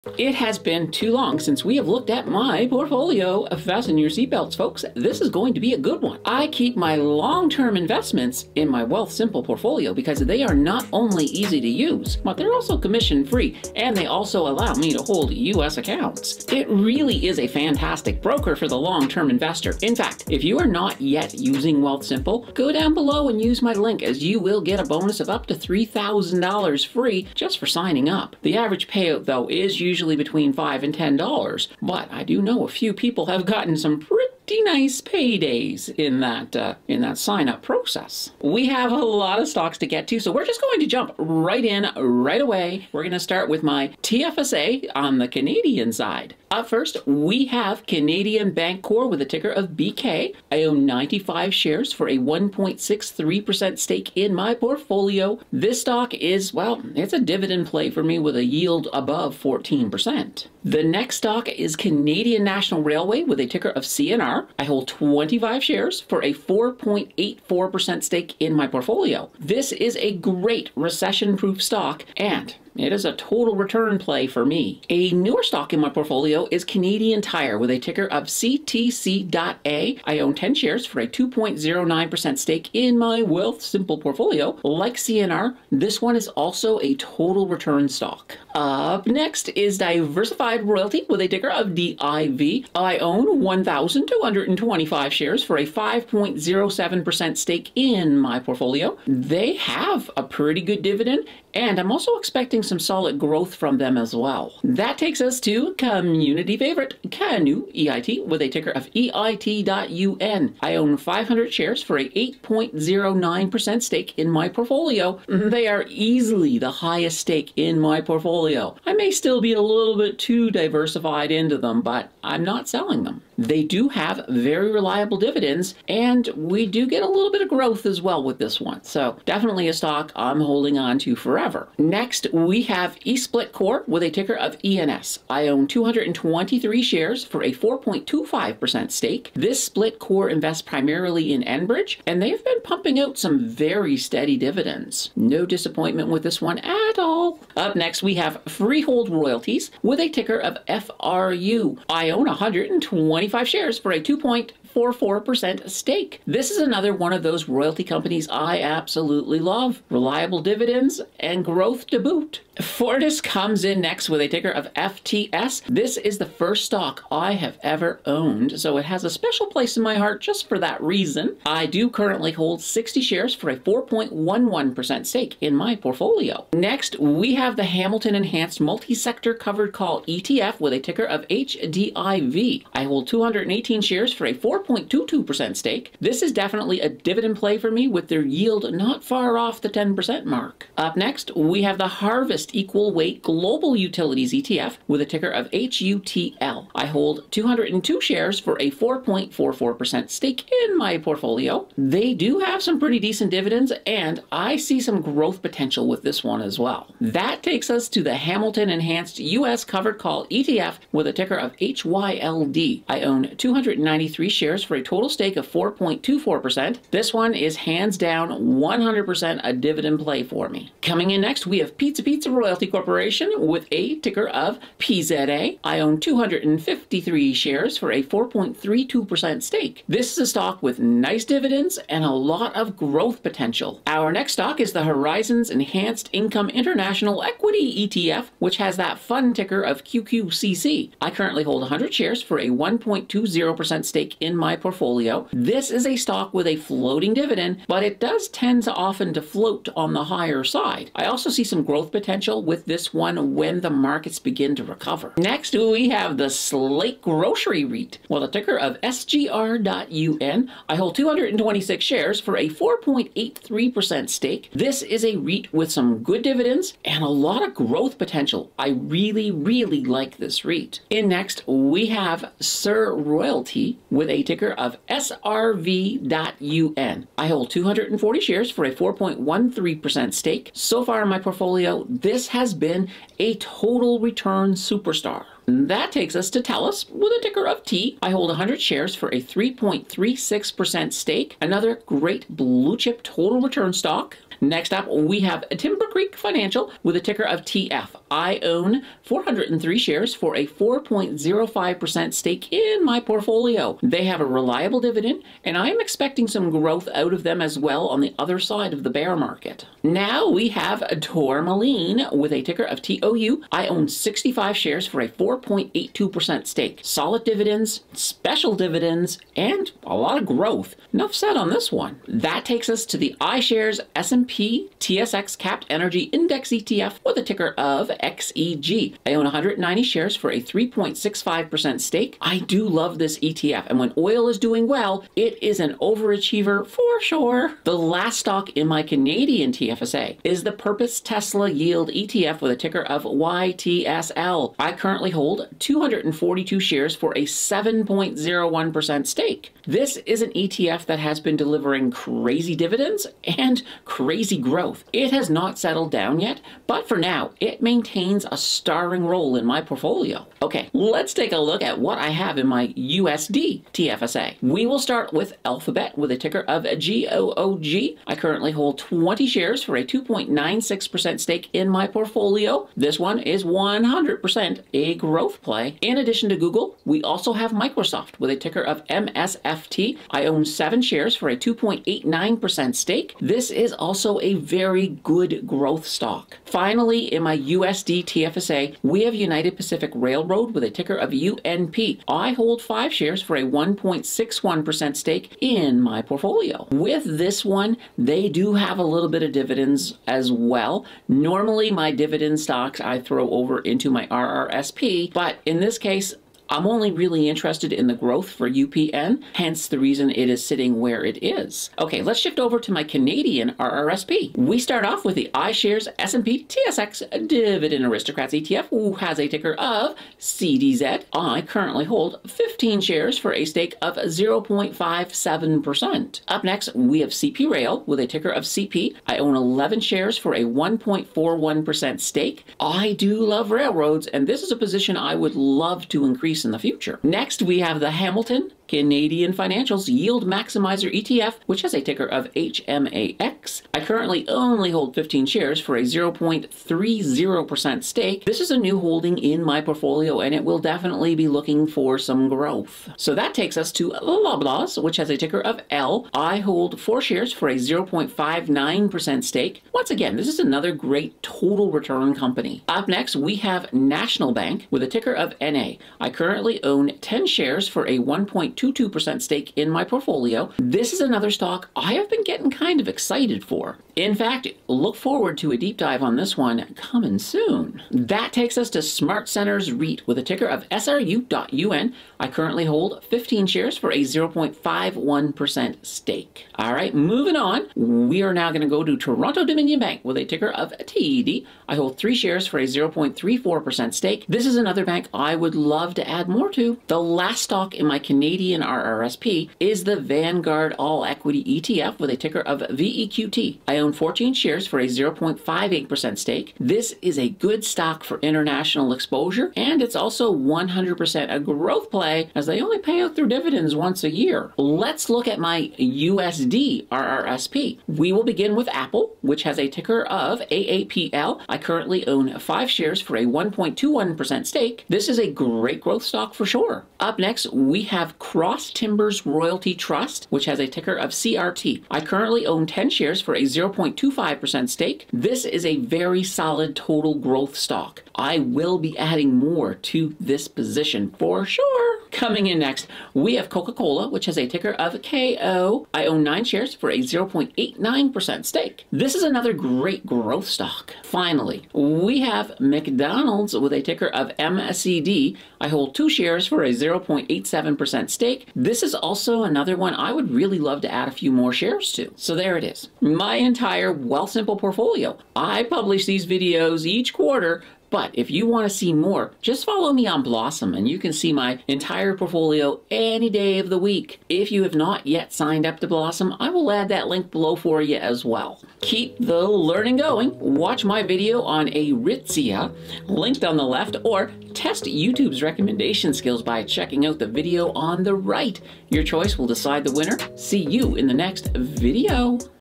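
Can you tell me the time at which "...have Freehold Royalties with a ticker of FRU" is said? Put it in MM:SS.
02:28.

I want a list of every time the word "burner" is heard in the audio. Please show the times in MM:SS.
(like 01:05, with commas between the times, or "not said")
not said.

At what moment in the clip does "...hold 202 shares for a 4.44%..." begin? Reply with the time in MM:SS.
03:16.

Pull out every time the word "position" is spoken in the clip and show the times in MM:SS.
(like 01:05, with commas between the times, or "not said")
07:14, 09:00.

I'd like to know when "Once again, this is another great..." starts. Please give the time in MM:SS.
07:39.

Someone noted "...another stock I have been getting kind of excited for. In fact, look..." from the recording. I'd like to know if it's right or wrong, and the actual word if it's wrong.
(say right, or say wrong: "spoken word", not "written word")
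right.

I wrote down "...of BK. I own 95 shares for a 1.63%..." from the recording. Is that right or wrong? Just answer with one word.
right.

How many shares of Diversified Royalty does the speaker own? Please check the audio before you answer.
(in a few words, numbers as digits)
1,225.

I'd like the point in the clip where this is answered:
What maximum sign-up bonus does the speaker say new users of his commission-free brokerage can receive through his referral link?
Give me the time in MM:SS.
00:25.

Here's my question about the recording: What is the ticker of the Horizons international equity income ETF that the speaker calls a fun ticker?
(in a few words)
QQCC.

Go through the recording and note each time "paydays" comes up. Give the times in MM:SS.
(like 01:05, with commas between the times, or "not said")
00:34.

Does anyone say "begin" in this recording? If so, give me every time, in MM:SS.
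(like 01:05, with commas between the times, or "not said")
04:14, 08:38.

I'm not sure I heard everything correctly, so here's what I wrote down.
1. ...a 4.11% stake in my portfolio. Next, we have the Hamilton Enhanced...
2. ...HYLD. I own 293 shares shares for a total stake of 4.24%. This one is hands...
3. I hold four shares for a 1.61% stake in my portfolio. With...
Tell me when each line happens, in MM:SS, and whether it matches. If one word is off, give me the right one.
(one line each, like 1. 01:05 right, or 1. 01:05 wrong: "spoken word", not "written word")
1. 02:53 right
2. 03:31 right
3. 06:32 wrong: "five", not "four".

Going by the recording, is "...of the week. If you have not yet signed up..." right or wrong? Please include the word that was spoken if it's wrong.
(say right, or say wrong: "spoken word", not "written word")
right.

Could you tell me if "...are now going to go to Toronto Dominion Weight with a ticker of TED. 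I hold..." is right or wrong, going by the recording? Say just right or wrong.
wrong.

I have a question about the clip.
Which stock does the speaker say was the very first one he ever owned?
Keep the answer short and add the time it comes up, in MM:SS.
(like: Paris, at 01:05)
Fortis, at 02:42.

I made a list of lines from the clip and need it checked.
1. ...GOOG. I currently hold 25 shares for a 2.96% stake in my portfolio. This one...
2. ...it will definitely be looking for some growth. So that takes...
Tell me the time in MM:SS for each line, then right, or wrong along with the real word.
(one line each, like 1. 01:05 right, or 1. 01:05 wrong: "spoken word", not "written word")
1. 06:06 wrong: "20", not "25"
2. 07:30 right.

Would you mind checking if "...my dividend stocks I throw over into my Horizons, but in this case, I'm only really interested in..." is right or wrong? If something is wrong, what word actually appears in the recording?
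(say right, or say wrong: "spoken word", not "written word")
wrong: "RRSP", not "Horizons".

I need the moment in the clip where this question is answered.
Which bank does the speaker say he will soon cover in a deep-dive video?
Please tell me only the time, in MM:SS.
07:43.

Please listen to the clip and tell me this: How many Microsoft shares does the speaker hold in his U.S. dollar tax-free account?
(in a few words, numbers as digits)
7.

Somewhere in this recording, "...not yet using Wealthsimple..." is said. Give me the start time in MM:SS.
00:20.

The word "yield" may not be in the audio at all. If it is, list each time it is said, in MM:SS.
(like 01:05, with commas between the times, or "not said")
00:58, 03:08, 05:41, 07:19.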